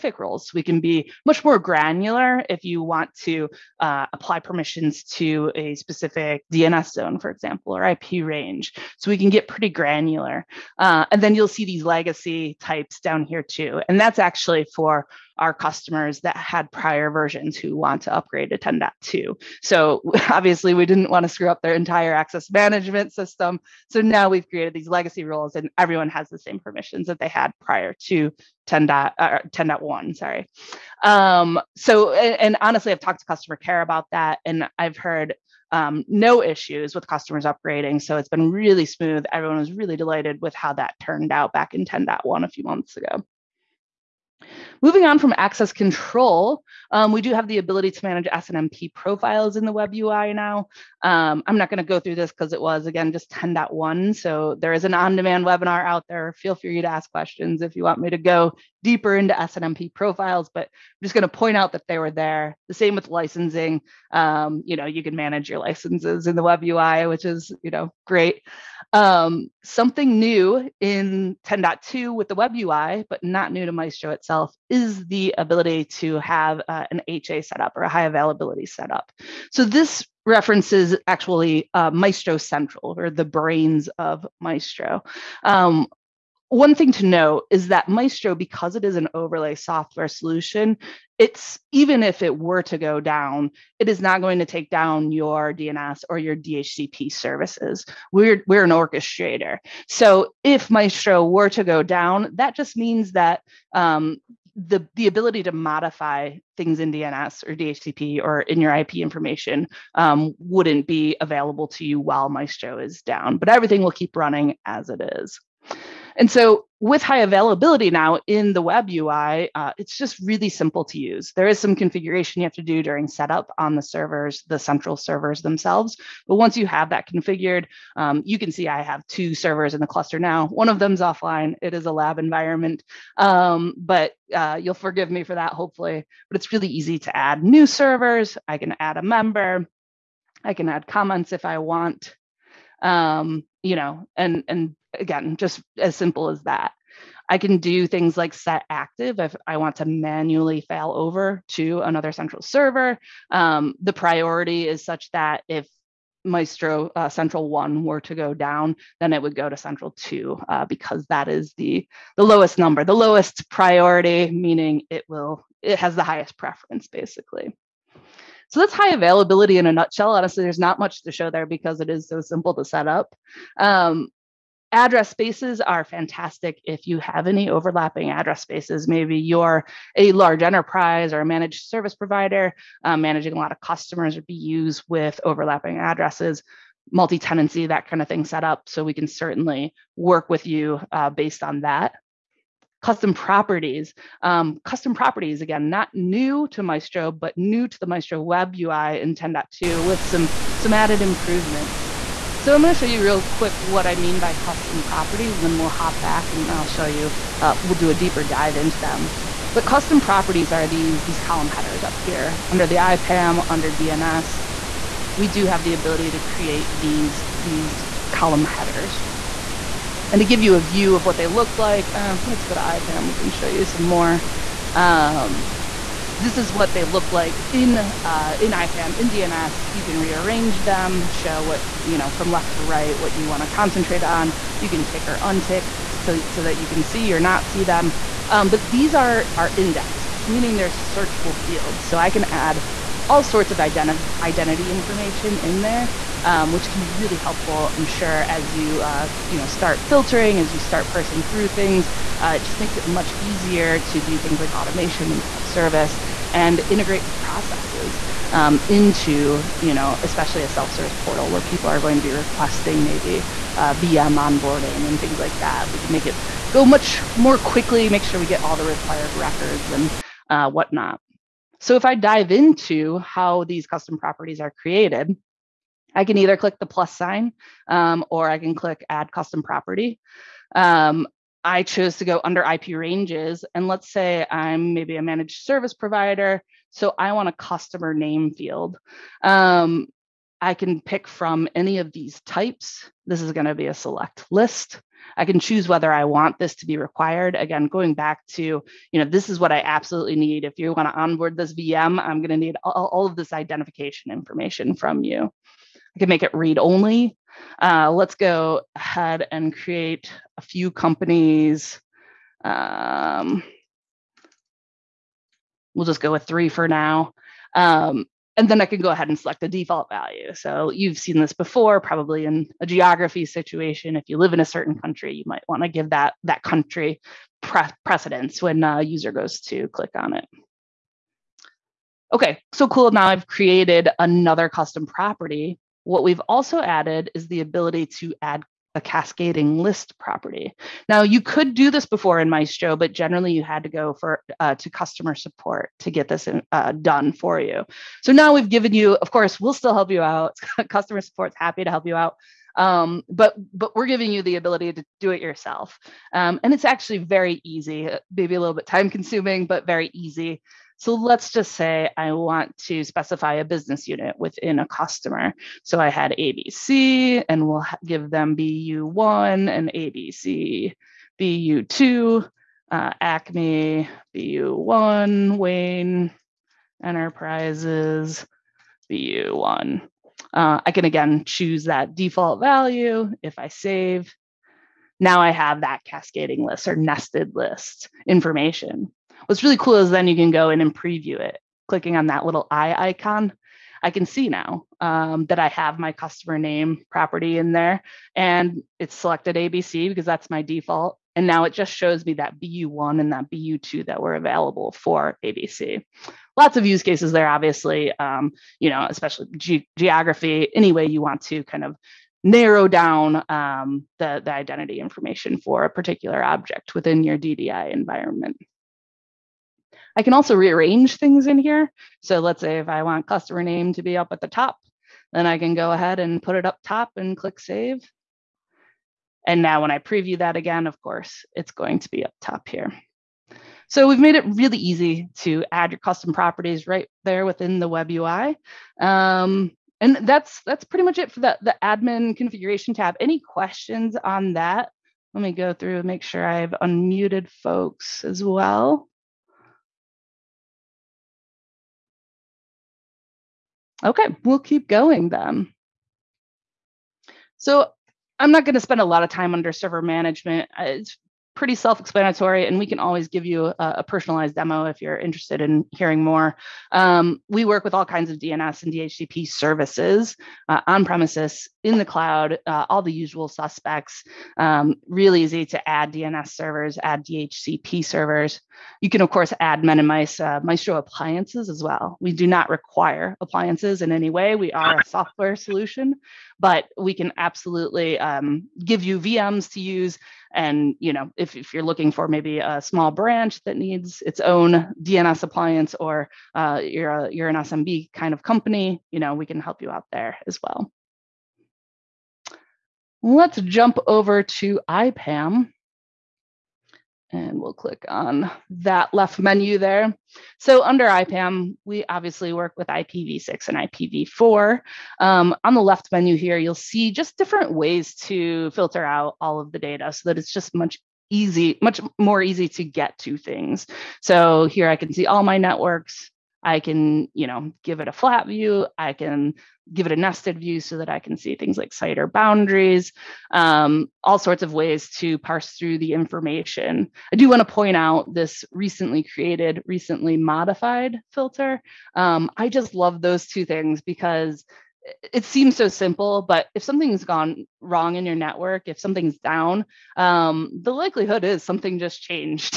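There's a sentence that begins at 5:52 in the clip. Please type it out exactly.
Um, but but we're giving you the ability to do it yourself, um, and it's actually very easy.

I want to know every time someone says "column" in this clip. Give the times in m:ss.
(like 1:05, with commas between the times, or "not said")
3:31, 3:38.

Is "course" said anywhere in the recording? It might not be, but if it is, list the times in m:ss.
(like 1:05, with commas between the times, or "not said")
5:49, 7:10, 7:59.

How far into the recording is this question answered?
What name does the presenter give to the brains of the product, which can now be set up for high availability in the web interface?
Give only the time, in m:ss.
1:21.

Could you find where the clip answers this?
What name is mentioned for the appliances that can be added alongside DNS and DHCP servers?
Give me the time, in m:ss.
7:59.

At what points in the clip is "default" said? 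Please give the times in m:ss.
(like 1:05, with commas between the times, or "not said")
5:19, 6:21, 6:40.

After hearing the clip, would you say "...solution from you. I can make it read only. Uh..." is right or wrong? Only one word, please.
wrong.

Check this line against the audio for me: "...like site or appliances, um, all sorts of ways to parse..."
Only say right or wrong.
wrong.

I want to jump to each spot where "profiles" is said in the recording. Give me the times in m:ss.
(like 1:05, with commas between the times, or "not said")
0:48, 0:59.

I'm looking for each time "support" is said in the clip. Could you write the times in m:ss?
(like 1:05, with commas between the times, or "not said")
5:45, 5:51.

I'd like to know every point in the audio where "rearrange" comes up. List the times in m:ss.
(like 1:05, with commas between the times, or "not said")
3:49, 7:00.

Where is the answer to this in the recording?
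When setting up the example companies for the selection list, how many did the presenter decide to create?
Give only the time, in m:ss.
5:16.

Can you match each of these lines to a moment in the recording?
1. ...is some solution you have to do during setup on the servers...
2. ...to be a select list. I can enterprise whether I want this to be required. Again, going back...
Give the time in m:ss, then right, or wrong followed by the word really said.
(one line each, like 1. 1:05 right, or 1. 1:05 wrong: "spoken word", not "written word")
1. 2:01 wrong: "configuration", not "solution"
2. 4:53 wrong: "choose", not "enterprise".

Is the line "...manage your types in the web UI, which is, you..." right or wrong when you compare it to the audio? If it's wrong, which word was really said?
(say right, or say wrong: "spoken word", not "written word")
wrong: "licenses", not "types".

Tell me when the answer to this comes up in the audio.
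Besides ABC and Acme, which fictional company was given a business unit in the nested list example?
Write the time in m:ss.
6:15.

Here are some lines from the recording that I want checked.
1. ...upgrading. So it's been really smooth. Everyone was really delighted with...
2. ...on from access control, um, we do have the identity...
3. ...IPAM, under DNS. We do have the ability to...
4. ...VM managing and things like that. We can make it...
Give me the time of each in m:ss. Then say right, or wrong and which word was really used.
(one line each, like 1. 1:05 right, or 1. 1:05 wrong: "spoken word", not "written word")
1. 0:37 right
2. 0:45 wrong: "ability", not "identity"
3. 3:32 right
4. 4:23 wrong: "onboarding", not "managing".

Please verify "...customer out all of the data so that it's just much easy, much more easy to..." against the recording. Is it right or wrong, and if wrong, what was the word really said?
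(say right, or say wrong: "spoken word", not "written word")
wrong: "filter", not "customer".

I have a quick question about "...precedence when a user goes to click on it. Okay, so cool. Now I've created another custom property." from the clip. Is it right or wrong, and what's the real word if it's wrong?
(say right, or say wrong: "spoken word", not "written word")
right.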